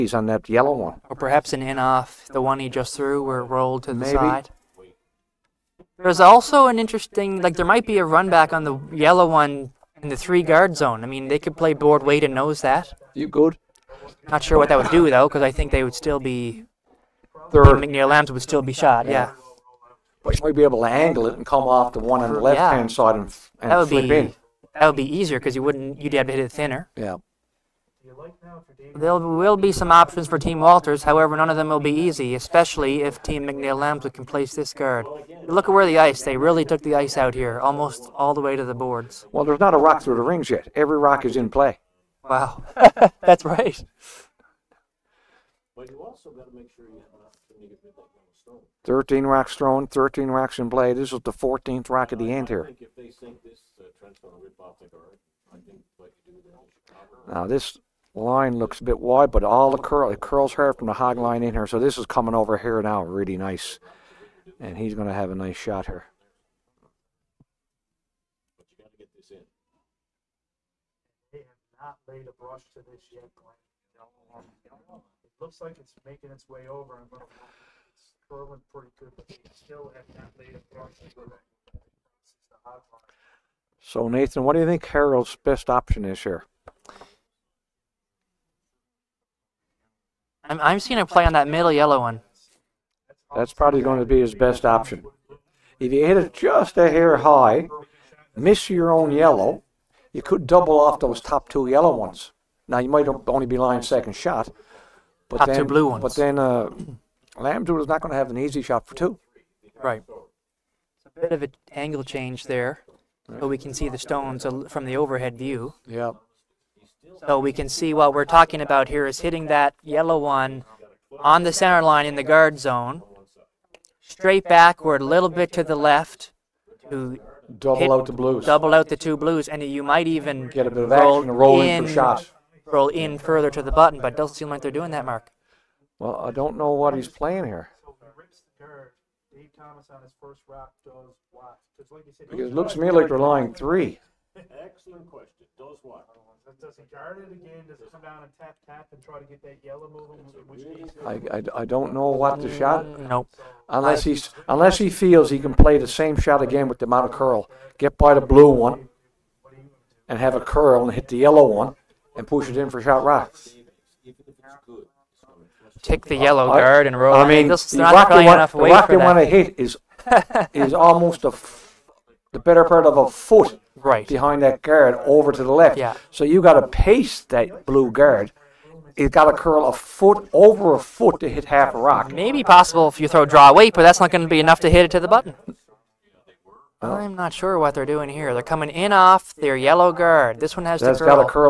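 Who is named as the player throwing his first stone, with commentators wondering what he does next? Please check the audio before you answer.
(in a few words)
Dave Thomas.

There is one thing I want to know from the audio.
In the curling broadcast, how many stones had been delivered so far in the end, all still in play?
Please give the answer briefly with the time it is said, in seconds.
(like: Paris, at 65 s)
13, at 48 s.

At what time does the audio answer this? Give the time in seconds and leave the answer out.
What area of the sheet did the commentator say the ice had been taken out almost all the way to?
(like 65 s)
38 s.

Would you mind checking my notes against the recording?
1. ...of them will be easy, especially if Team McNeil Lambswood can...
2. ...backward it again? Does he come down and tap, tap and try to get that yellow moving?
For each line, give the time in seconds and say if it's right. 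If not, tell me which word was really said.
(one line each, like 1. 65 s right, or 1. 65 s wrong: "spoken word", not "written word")
1. 31 s right
2. 146 s wrong: "guard", not "backward".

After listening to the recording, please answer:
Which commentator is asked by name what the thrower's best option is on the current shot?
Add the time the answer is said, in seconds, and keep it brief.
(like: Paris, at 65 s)
Nathan, at 84 s.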